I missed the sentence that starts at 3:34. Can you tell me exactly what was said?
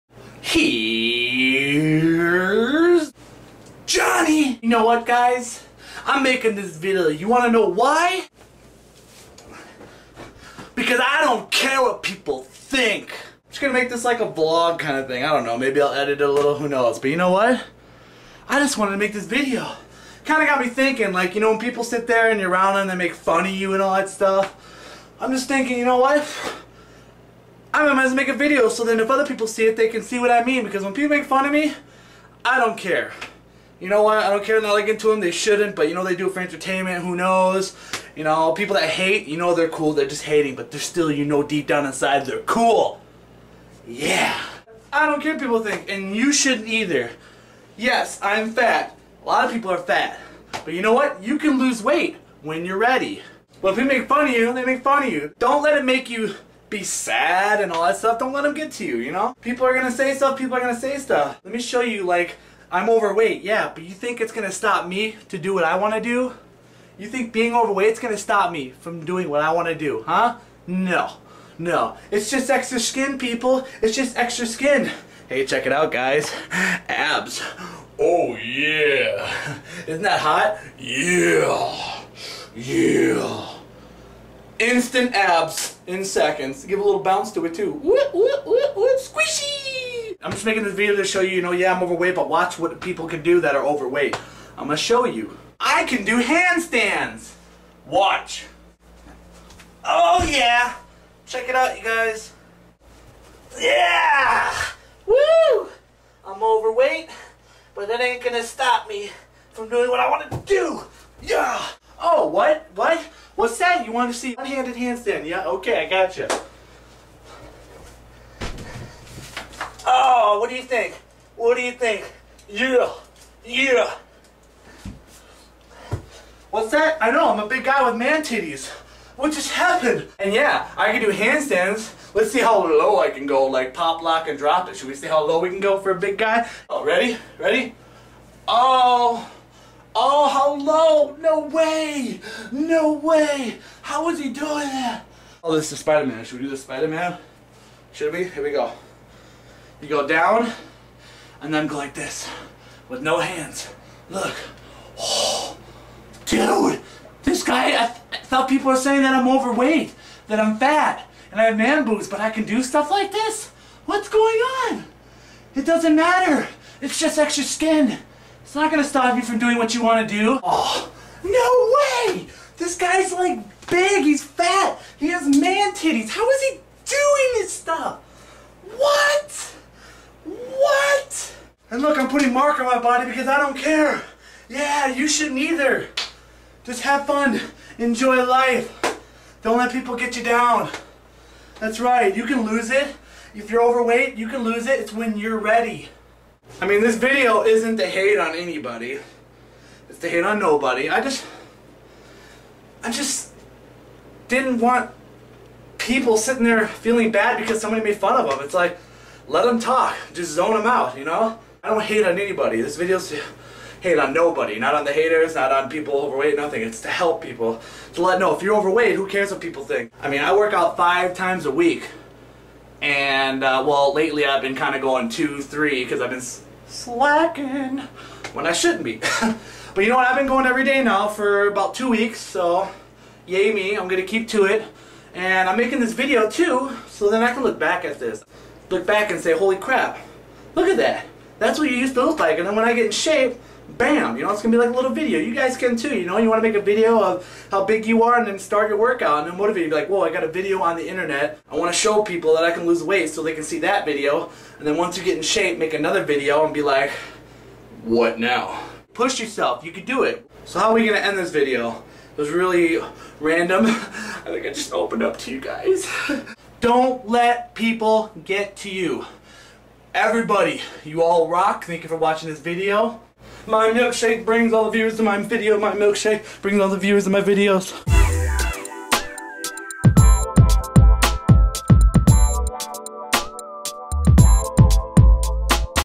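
Not on the haters, not on people overweight, nothing.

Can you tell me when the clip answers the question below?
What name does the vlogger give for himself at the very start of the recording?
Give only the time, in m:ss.
0:03.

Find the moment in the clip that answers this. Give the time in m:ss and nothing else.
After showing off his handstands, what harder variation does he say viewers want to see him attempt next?
1:54.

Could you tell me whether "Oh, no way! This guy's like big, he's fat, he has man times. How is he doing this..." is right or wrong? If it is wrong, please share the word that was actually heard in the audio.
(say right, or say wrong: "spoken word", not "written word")
wrong: "titties", not "times".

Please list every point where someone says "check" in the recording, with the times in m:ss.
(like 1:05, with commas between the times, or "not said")
1:15, 1:41.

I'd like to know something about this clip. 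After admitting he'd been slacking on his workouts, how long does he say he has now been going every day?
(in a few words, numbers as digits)
About 2 weeks.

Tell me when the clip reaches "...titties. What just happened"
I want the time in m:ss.
2:08.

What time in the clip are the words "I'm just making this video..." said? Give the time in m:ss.
1:30.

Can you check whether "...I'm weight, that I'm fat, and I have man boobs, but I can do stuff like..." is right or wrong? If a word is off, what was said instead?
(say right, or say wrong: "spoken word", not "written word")
wrong: "overweight", not "weight".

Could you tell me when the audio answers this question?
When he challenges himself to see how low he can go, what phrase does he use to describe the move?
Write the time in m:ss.
2:13.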